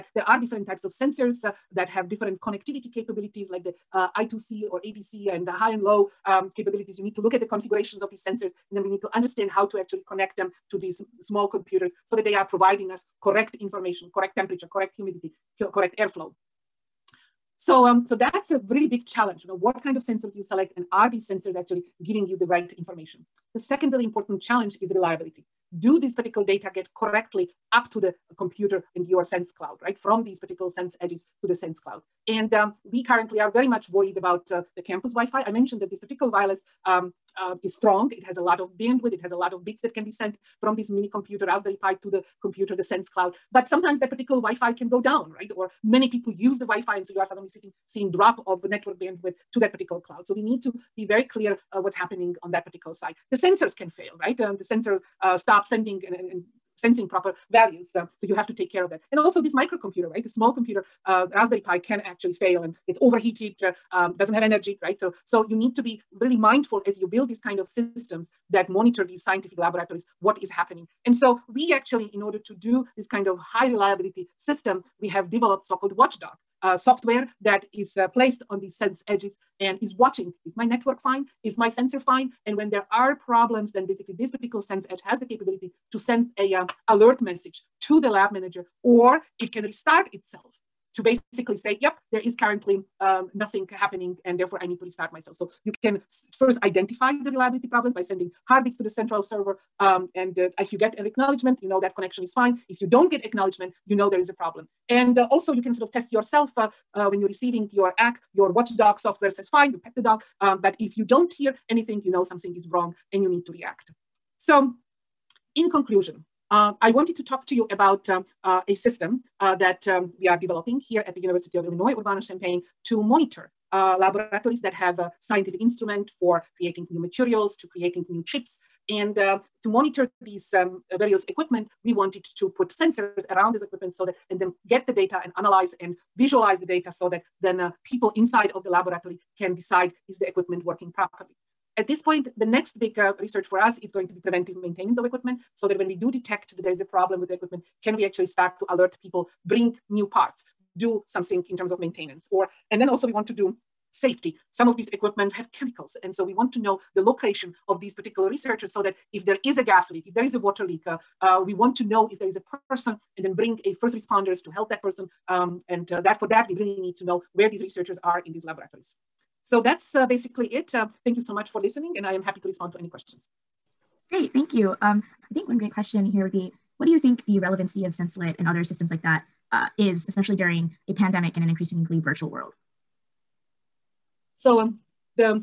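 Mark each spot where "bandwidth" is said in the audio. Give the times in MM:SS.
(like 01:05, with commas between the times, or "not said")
00:38, 00:48.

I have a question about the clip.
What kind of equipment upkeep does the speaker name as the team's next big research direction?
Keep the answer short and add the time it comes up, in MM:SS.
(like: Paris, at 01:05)
Preventive maintenance, at 02:24.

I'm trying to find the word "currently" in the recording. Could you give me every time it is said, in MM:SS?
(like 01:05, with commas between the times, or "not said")
00:33, 01:32.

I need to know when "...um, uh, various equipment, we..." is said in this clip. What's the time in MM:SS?
02:10.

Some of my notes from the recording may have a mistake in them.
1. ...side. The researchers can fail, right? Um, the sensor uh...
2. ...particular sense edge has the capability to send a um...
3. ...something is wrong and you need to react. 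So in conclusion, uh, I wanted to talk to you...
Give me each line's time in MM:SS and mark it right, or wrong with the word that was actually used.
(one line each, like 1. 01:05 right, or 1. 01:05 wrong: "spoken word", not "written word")
1. 00:52 wrong: "sensors", not "researchers"
2. 01:24 right
3. 01:52 right.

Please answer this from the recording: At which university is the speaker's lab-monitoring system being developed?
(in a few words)
University of Illinois Urbana-Champaign.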